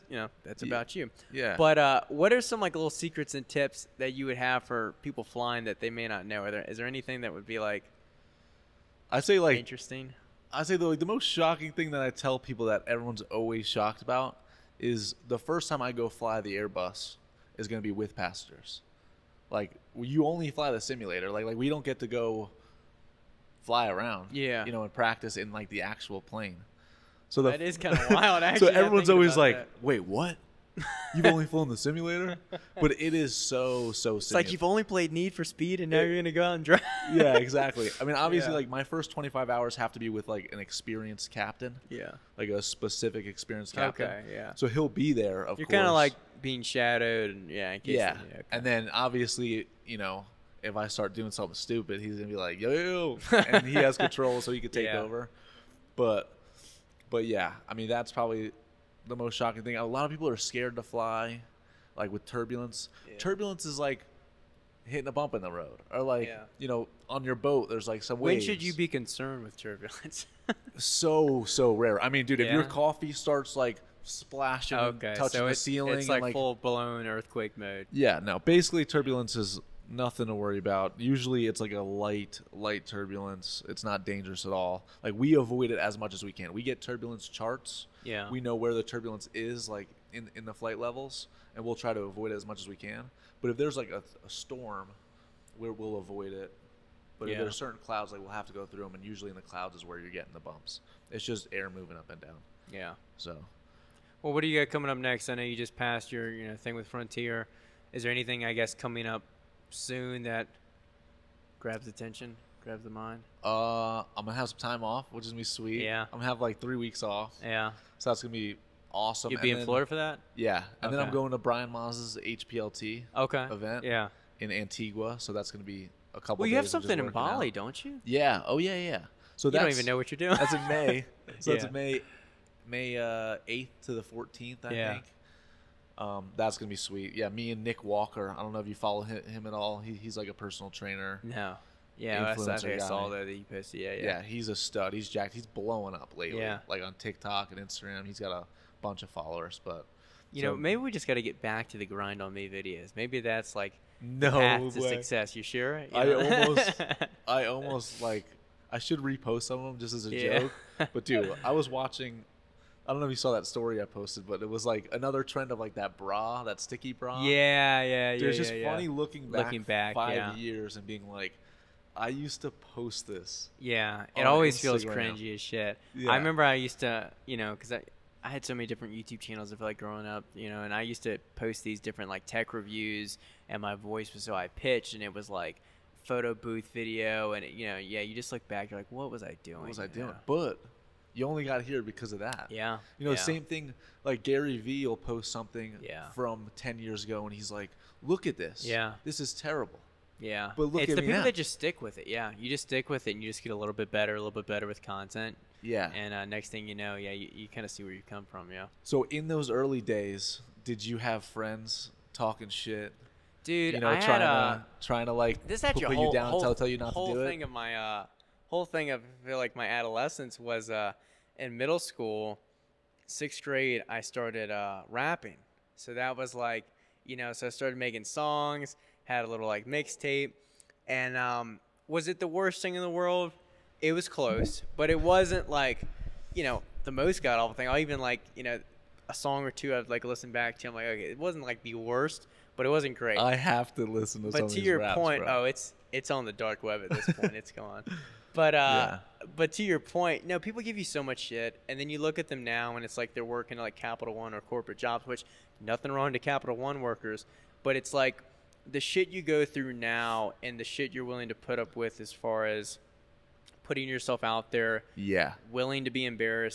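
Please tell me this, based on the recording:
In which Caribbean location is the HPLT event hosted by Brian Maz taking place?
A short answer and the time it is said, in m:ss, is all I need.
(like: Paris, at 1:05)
Antigua, at 2:04.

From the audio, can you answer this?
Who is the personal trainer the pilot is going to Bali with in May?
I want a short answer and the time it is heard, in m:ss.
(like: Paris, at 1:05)
Nick Walker, at 2:17.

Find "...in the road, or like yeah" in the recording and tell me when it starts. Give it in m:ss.
1:05.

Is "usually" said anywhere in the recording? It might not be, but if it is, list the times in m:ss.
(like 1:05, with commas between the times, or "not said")
1:20, 1:39.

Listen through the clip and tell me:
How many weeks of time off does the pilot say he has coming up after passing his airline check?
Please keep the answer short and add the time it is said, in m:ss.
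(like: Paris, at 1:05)
3, at 1:56.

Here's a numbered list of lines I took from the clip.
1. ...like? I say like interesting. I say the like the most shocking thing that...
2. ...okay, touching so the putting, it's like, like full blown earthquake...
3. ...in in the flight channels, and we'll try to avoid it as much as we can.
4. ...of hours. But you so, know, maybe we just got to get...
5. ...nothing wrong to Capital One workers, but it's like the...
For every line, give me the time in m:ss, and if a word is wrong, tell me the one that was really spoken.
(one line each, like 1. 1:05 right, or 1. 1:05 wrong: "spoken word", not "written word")
1. 0:07 right
2. 1:14 wrong: "ceiling", not "putting"
3. 1:30 wrong: "levels", not "channels"
4. 2:29 wrong: "followers", not "hours"
5. 4:15 right.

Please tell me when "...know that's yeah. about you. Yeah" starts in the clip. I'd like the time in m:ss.
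0:00.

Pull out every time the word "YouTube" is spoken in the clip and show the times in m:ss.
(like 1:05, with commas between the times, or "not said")
2:58.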